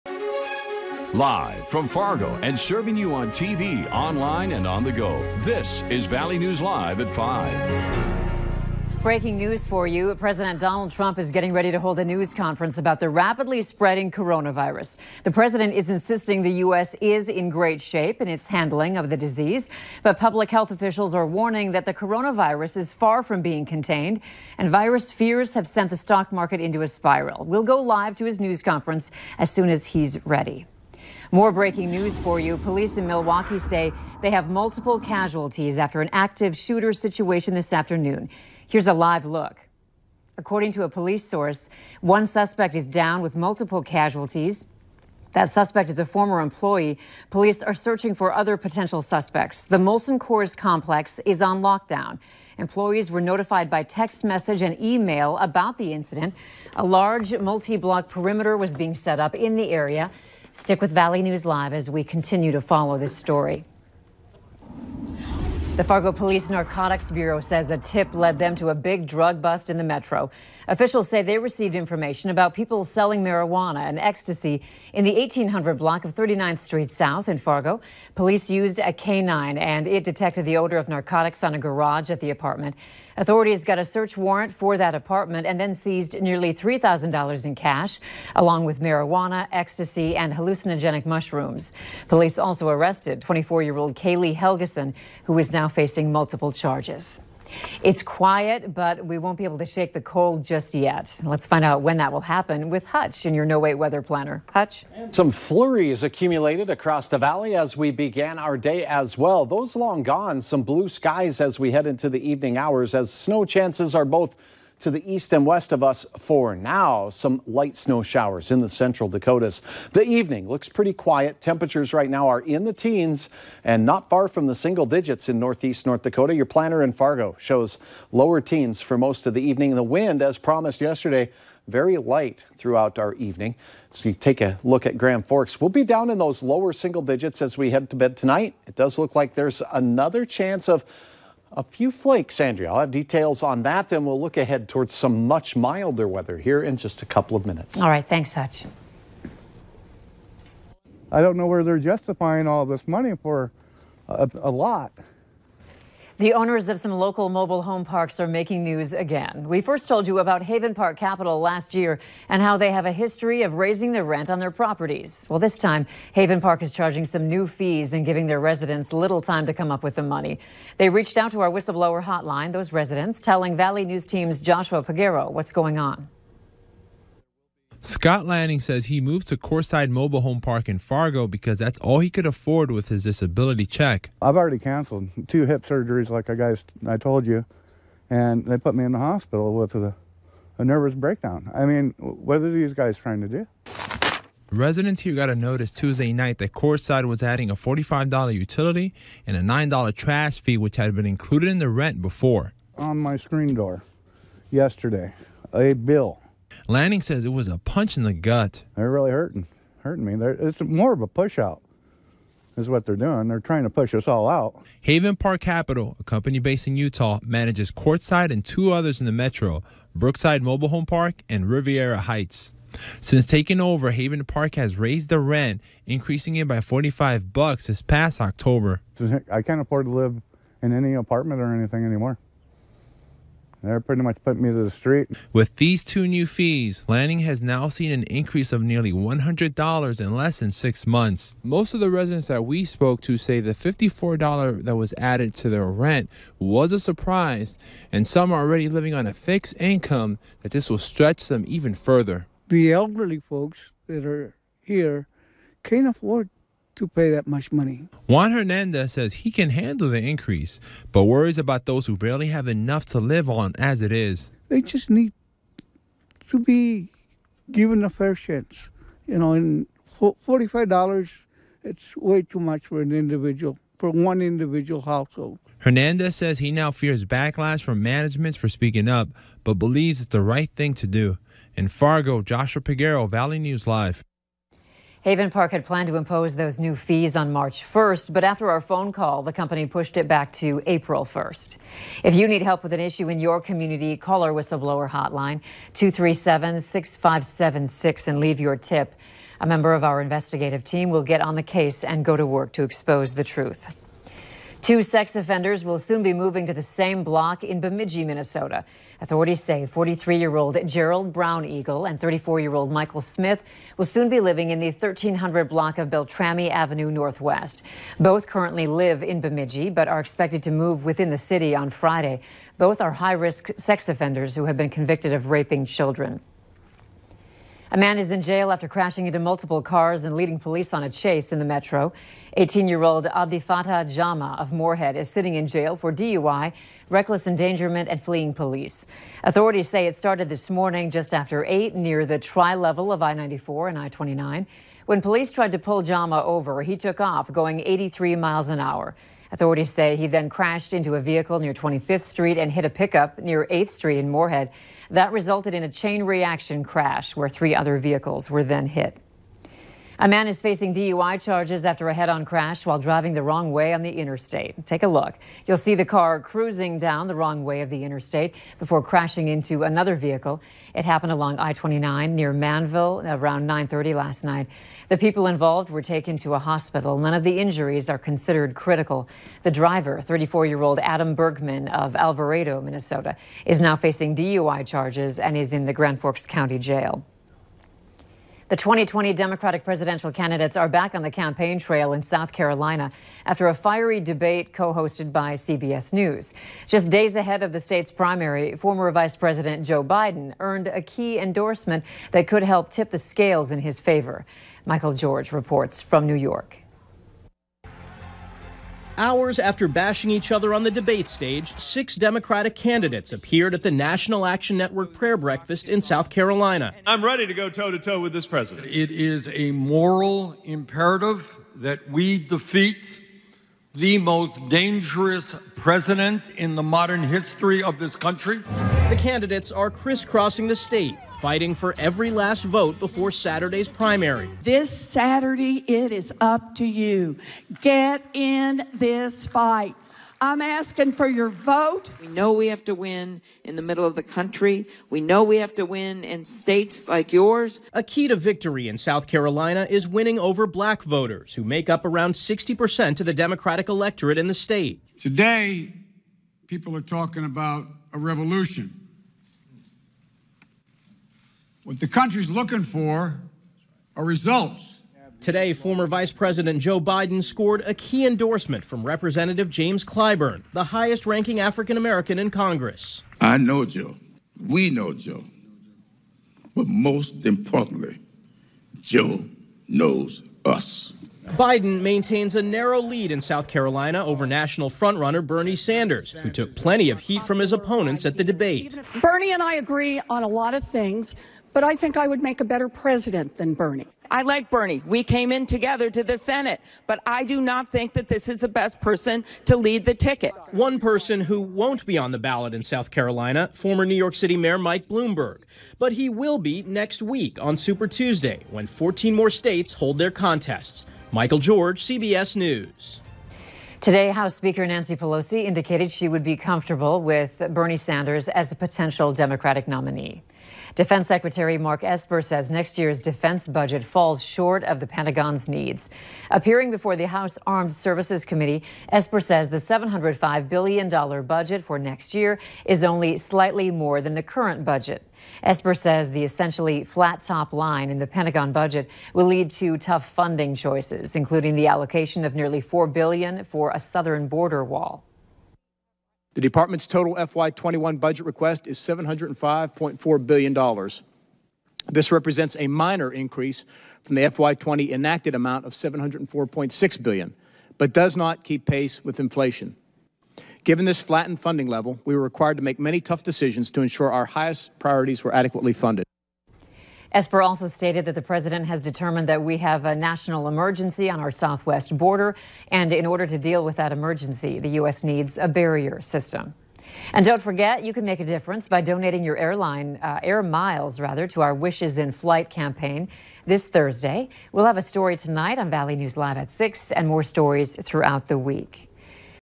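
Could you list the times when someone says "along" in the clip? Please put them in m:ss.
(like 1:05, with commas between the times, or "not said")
1:28, 6:11.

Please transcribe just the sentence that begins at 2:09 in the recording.
The wind, as promised yesterday, very light throughout our evening.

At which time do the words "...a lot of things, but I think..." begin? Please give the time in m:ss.
8:10.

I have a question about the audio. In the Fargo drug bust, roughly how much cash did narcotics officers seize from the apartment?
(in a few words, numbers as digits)
$3,000.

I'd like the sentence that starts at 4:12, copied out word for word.
The elderly folks that are here can't afford to pay that much money.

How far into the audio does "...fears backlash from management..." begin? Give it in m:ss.
4:36.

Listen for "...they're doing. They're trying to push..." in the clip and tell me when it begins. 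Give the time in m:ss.
3:32.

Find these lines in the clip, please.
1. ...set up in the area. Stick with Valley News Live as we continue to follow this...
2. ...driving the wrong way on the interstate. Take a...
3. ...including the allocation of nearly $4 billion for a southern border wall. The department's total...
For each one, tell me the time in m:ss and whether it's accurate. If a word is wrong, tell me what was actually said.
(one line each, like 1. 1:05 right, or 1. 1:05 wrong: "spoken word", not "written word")
1. 0:58 right
2. 6:02 right
3. 9:01 right.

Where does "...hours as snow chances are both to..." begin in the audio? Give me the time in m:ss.
1:52.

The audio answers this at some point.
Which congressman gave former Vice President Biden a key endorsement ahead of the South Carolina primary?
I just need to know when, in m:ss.
7:49.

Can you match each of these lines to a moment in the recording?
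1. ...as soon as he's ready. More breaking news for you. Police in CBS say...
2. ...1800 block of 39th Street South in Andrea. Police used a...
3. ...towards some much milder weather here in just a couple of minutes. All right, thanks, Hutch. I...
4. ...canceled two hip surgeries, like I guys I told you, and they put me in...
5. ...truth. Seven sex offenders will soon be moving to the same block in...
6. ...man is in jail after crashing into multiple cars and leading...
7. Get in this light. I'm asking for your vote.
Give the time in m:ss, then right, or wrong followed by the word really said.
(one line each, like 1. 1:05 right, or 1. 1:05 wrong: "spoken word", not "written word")
1. 0:29 wrong: "Milwaukee", not "CBS"
2. 1:15 wrong: "Fargo", not "Andrea"
3. 2:24 right
4. 3:04 right
5. 5:03 wrong: "Two", not "Seven"
6. 5:27 right
7. 7:17 wrong: "fight", not "light".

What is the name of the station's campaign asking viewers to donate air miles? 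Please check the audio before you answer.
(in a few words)
Wishes in Flight.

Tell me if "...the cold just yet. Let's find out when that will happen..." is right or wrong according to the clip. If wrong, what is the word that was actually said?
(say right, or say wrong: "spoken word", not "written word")
right.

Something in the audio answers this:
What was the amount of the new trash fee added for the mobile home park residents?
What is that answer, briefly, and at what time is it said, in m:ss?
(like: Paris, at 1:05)
$9, at 3:19.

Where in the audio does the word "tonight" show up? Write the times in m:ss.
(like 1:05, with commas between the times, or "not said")
2:18, 9:45.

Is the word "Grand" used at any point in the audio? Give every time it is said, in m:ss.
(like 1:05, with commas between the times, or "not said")
2:14, 6:25.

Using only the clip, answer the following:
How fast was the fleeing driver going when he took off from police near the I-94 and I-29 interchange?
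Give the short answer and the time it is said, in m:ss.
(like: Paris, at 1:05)
83 miles per hour, at 5:47.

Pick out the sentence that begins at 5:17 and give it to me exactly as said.
Both currently live in Bemidji but are expected to move within the city on Friday.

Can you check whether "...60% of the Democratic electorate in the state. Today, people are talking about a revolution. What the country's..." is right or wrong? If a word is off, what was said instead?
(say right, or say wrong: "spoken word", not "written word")
right.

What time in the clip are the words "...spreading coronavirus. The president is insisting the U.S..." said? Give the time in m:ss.
0:13.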